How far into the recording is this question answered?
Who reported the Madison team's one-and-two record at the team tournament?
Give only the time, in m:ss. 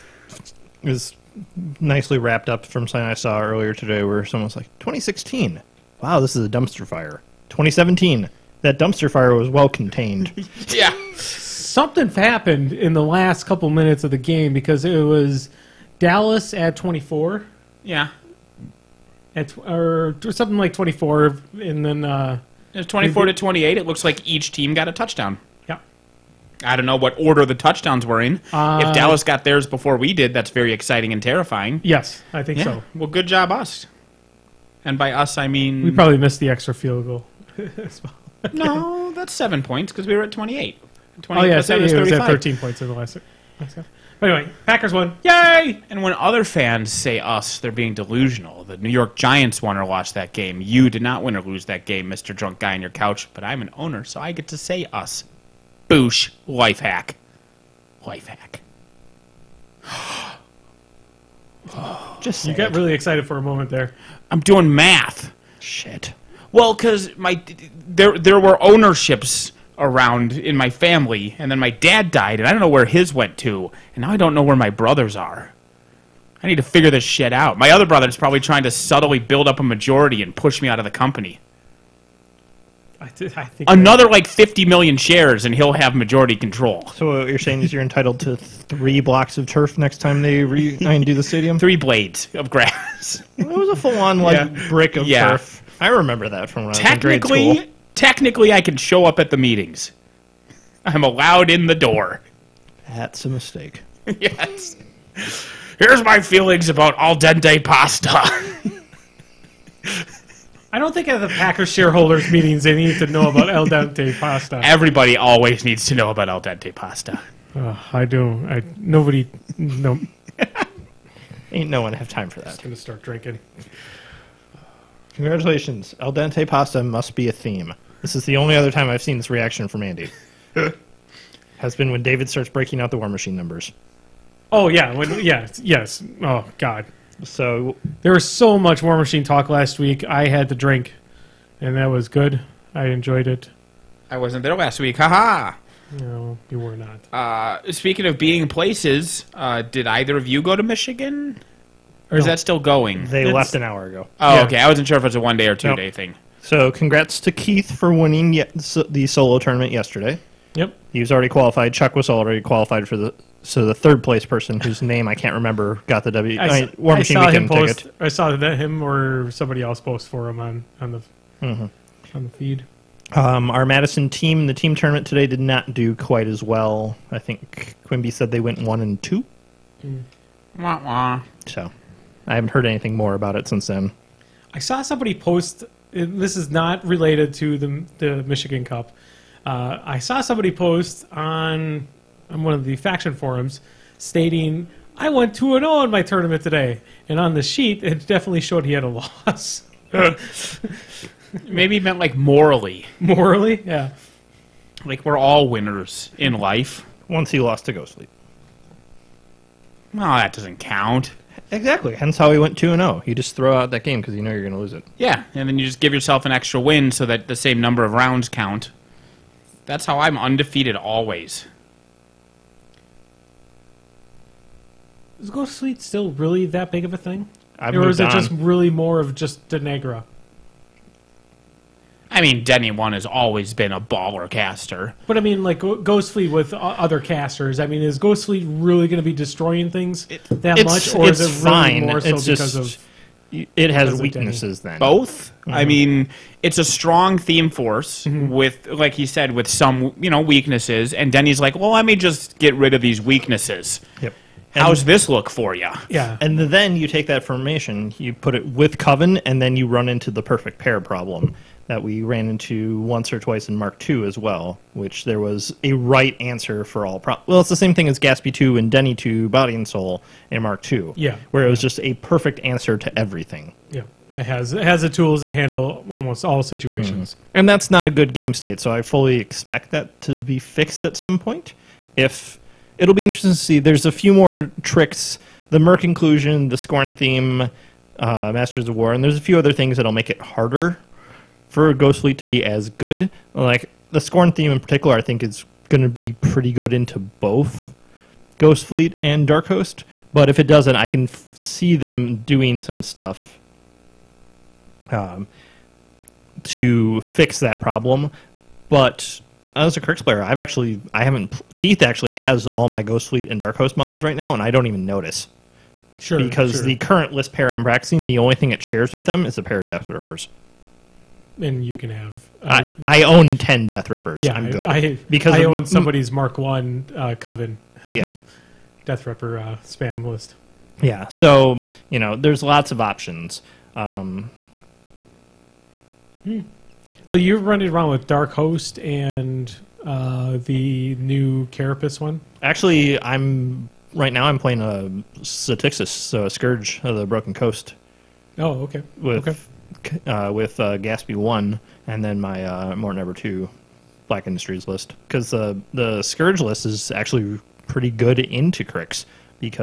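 2:57.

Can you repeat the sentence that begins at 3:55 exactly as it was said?
But I mean, like Fleet with other casters.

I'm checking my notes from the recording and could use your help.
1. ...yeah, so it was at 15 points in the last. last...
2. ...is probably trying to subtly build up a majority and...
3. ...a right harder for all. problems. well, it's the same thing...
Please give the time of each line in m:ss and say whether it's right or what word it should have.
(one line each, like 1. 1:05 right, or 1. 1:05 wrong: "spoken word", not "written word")
1. 0:41 wrong: "13", not "15"
2. 1:18 right
3. 4:25 wrong: "answer", not "harder".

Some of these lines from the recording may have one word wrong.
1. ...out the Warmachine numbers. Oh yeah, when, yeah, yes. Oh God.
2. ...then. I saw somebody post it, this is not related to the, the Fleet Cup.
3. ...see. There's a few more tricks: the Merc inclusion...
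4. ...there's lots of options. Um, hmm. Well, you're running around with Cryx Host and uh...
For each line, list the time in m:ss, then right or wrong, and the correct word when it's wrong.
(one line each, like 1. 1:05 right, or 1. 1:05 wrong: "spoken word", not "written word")
1. 2:12 right
2. 3:03 wrong: "Michigan", not "Fleet"
3. 4:43 right
4. 5:32 wrong: "Dark", not "Cryx".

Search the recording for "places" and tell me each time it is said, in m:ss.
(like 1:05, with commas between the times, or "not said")
2:28, 2:44.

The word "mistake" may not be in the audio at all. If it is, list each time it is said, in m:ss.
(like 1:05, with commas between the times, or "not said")
1:43.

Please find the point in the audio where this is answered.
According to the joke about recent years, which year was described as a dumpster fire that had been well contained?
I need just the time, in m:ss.
0:07.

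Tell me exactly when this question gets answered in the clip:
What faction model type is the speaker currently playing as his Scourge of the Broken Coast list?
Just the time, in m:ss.
5:45.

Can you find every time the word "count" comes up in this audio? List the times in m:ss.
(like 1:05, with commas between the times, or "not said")
3:30, 3:38.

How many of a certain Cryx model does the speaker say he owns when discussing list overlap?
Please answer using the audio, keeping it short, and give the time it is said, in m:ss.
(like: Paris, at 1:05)
10, at 5:23.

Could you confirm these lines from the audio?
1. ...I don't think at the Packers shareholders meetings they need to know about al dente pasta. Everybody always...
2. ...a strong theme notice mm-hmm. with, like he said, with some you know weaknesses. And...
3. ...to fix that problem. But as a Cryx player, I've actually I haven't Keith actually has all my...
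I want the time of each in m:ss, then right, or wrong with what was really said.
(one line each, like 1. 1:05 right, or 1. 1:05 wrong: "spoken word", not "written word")
1. 1:50 right
2. 4:06 wrong: "force", not "notice"
3. 5:06 right.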